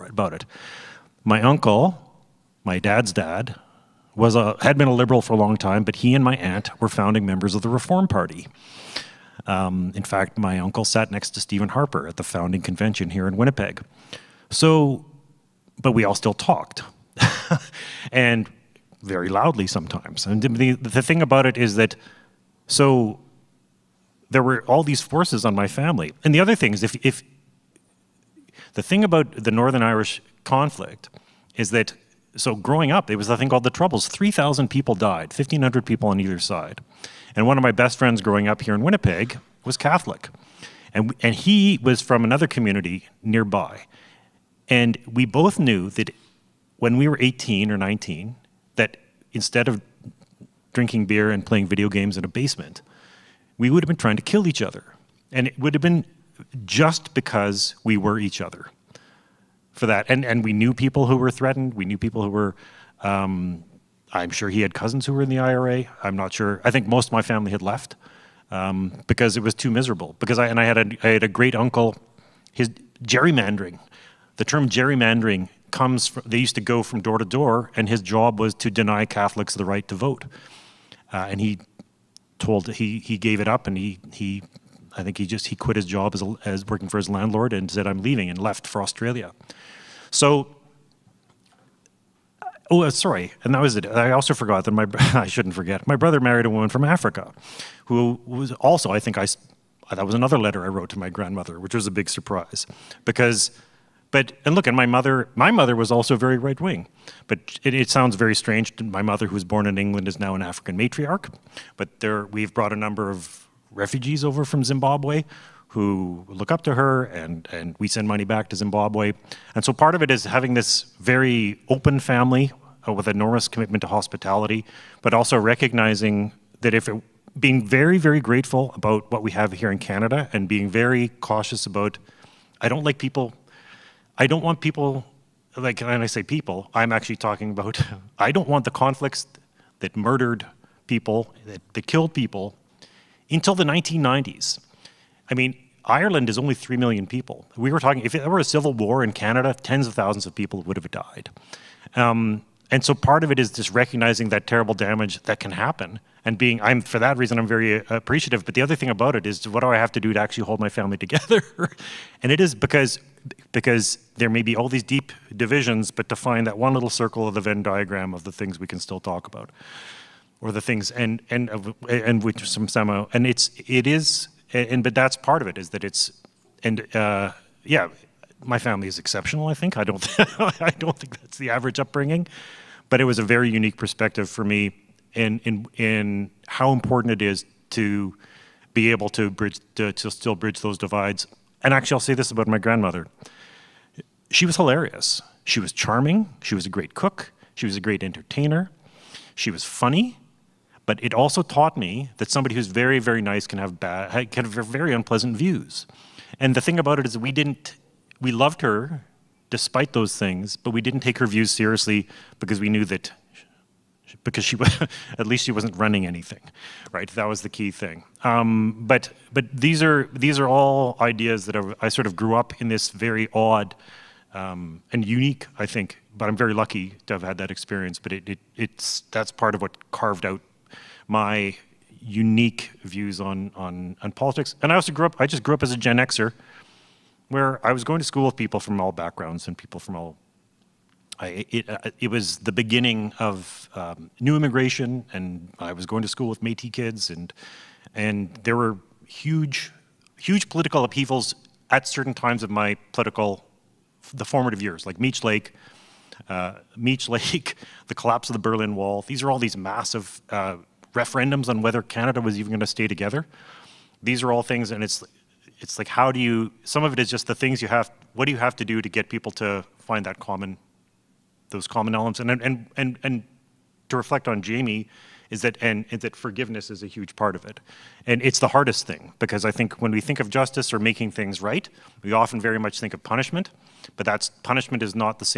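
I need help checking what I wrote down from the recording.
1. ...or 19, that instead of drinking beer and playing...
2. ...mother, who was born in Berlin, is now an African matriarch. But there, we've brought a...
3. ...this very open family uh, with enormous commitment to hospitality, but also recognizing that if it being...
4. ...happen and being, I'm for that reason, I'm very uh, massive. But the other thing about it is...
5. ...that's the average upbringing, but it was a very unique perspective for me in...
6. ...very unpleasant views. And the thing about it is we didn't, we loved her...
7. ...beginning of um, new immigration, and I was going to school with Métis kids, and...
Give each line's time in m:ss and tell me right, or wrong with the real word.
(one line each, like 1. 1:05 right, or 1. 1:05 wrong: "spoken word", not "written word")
1. 0:47 right
2. 1:49 wrong: "England", not "Berlin"
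3. 2:00 right
4. 2:35 wrong: "appreciative", not "massive"
5. 3:01 right
6. 3:24 right
7. 4:02 right.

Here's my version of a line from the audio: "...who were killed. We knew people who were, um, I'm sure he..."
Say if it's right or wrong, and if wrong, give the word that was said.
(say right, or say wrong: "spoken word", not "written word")
wrong: "threatened", not "killed".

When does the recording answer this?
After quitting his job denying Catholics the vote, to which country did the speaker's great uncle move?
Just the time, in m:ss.
1:28.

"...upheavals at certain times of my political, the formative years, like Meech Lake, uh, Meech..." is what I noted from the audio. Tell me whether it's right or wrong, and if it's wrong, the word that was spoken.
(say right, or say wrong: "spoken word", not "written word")
right.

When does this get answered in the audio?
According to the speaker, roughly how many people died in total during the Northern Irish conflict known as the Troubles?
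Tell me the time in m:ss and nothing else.
0:34.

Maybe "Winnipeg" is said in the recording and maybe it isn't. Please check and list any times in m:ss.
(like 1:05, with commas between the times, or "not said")
0:13, 0:38.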